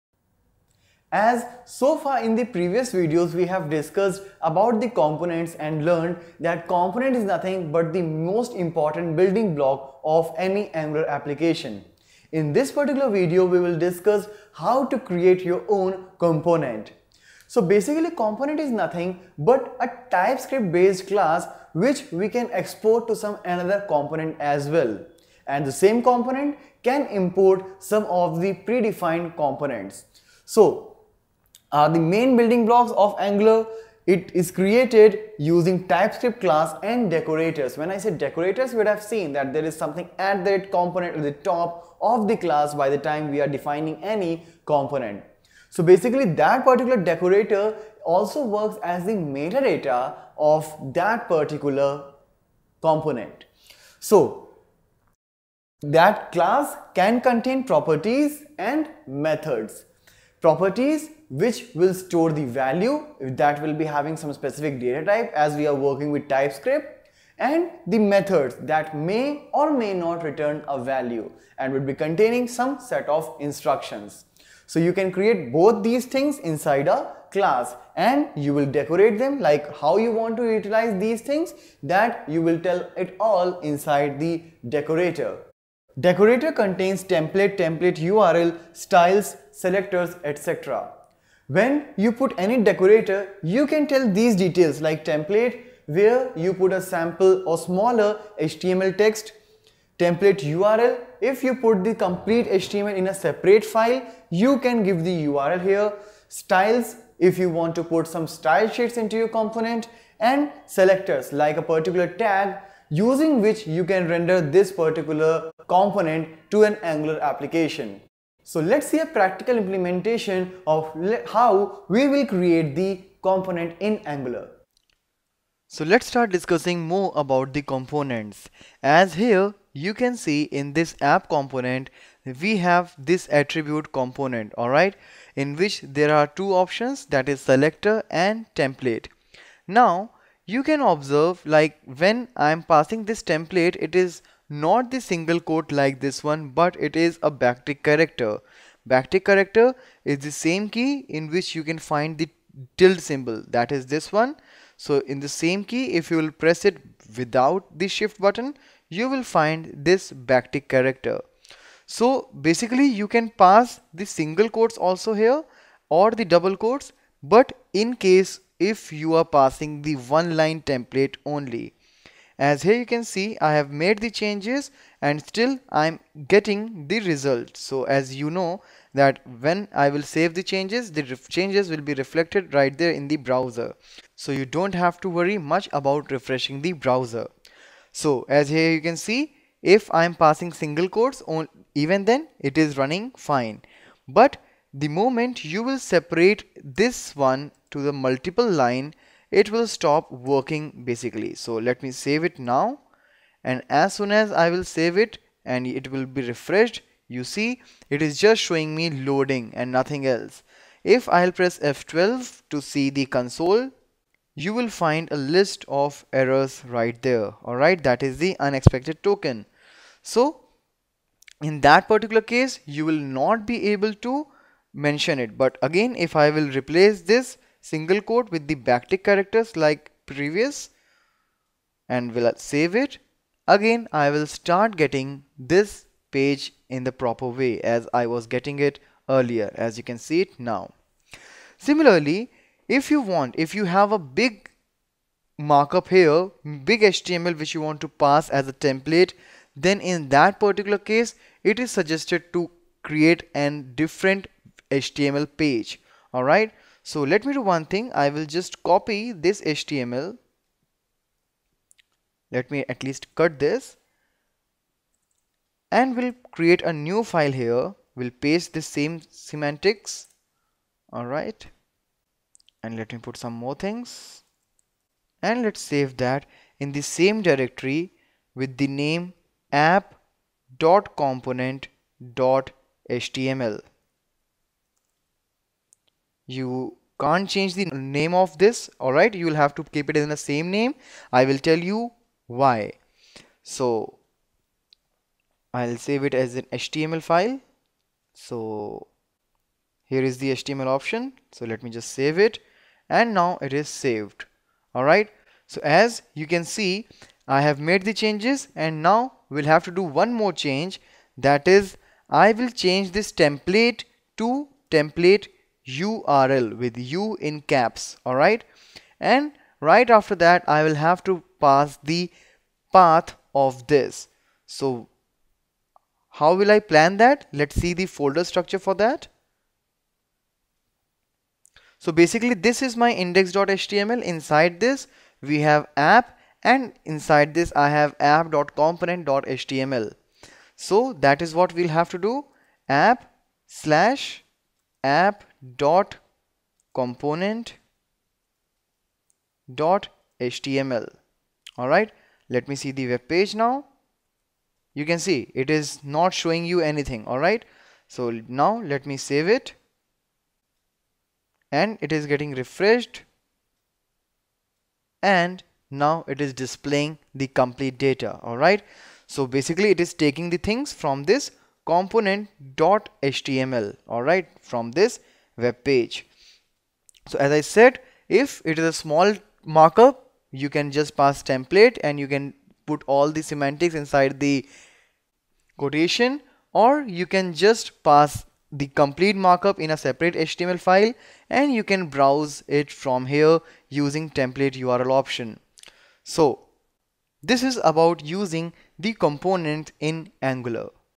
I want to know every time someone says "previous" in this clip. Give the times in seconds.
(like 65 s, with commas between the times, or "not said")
2 s, 230 s.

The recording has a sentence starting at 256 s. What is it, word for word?
Alright, so let me do one thing.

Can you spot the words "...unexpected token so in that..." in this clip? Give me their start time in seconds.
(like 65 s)
218 s.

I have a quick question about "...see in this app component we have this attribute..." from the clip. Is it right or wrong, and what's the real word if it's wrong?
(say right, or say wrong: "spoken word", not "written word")
right.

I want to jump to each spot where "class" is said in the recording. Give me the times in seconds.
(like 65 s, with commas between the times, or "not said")
21 s, 36 s, 42 s, 56 s, 77 s.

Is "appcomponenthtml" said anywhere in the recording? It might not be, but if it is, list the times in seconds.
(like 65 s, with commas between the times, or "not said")
279 s, 337 s.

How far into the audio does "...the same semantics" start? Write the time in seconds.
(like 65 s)
268 s.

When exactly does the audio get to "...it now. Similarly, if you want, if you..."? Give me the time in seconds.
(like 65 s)
240 s.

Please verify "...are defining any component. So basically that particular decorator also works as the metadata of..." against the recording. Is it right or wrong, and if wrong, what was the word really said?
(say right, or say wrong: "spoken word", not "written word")
right.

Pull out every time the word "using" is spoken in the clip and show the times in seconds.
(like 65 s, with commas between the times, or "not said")
35 s, 112 s, 393 s, 398 s.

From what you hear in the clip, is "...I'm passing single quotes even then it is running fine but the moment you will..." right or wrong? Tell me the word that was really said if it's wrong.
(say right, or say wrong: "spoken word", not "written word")
right.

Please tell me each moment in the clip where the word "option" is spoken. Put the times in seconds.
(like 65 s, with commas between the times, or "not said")
136 s, 300 s, 394 s.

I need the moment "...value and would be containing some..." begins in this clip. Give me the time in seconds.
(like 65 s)
70 s.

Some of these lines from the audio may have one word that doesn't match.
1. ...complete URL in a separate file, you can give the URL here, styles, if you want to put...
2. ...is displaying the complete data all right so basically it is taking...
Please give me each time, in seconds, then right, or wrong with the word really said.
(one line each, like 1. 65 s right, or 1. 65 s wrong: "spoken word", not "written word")
1. 102 s wrong: "HTML", not "URL"
2. 366 s right.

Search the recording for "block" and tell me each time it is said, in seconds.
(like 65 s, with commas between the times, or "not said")
9 s, 32 s.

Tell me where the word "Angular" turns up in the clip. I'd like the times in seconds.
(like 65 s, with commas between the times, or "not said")
10 s, 33 s, 116 s, 123 s, 400 s.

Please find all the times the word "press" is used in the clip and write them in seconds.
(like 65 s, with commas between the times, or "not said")
156 s, 211 s.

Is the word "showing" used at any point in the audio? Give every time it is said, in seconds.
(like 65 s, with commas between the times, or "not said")
208 s, 356 s.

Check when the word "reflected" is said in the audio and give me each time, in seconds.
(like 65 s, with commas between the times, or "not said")
181 s.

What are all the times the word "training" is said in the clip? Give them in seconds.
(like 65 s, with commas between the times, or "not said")
not said.